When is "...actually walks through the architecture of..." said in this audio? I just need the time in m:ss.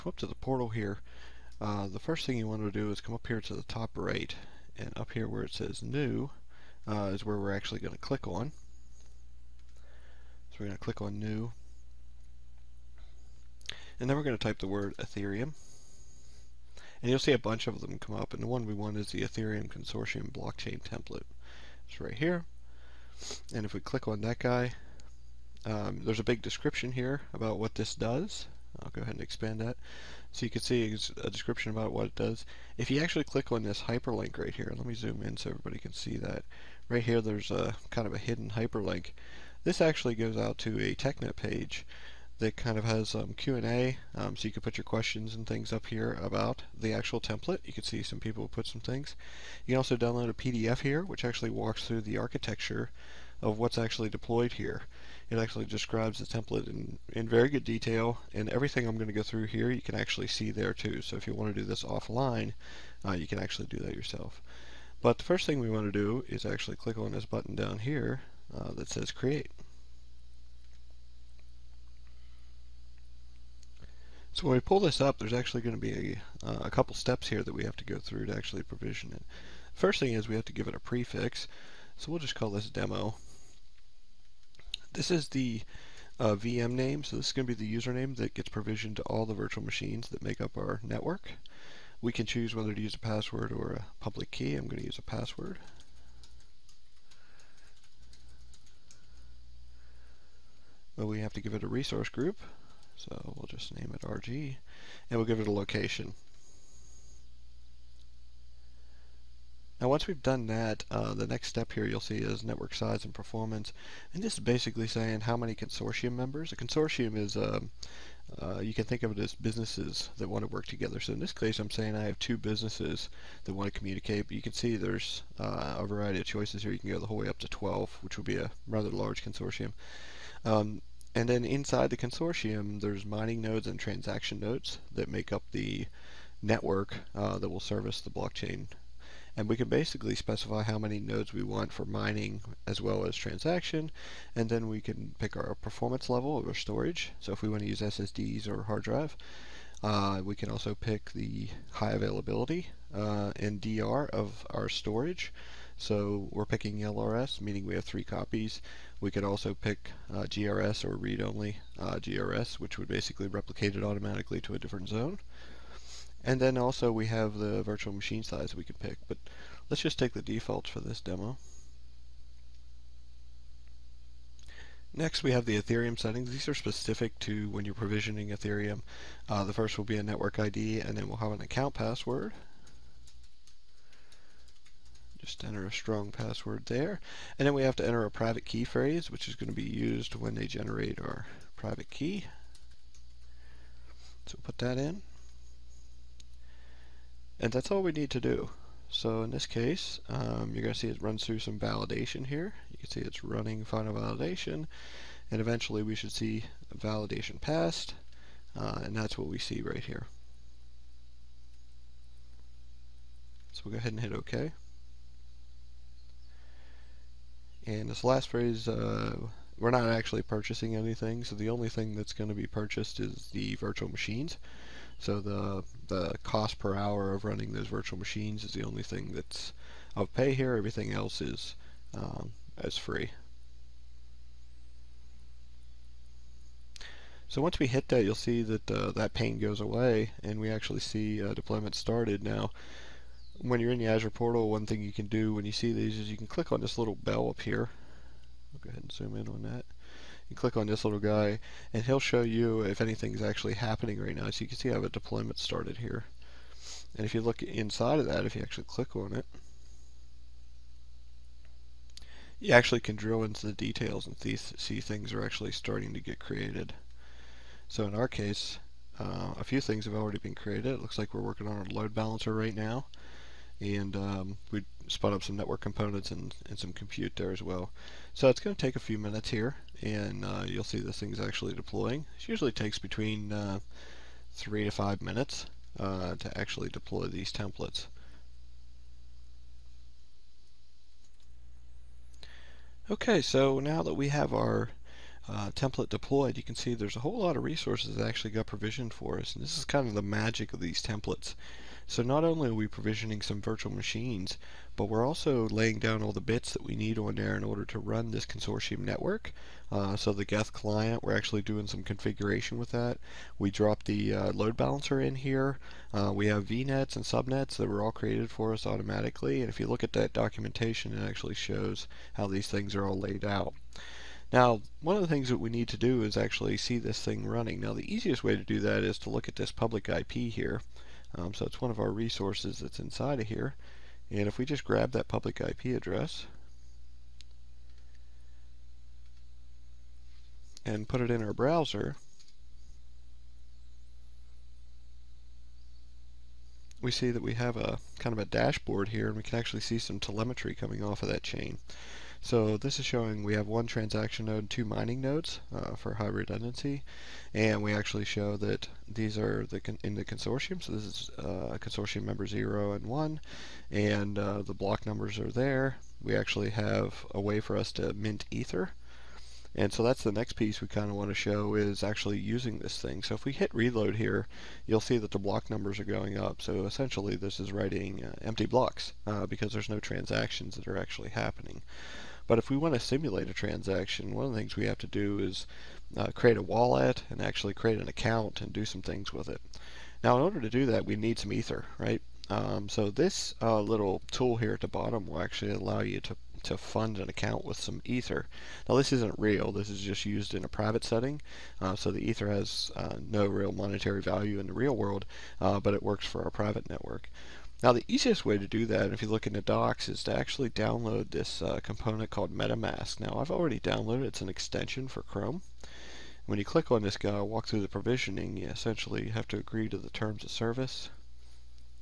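0:51.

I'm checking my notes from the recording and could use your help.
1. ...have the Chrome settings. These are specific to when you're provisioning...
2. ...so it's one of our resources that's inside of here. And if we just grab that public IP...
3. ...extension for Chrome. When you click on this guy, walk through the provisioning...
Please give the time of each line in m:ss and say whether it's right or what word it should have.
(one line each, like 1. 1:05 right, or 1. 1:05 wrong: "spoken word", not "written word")
1. 2:55 wrong: "Ethereum", not "Chrome"
2. 5:31 right
3. 6:54 right.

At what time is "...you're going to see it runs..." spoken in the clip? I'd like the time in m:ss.
3:20.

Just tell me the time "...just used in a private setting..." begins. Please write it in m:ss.
6:39.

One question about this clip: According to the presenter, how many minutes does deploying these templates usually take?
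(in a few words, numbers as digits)
3 to 5 minutes.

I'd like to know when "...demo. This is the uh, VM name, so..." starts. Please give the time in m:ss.
1:22.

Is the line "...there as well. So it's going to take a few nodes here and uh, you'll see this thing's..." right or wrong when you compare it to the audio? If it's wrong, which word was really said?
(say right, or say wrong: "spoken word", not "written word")
wrong: "minutes", not "nodes".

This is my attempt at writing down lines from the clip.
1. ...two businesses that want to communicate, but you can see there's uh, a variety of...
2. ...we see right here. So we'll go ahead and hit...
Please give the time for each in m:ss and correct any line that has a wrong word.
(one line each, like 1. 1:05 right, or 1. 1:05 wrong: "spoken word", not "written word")
1. 2:02 right
2. 3:29 right.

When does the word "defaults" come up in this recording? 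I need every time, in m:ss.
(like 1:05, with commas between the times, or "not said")
2:50.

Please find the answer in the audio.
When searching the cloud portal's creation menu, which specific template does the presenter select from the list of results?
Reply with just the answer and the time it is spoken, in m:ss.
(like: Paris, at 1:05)
Ethereum Consortium blockchain template, at 0:19.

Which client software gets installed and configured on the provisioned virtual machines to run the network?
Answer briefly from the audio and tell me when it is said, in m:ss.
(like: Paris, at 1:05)
Geth, at 5:10.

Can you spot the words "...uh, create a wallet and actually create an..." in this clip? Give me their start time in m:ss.
6:25.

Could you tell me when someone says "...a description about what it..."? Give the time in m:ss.
0:31.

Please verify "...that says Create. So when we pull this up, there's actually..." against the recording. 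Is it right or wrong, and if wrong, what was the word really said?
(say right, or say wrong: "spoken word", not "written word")
right.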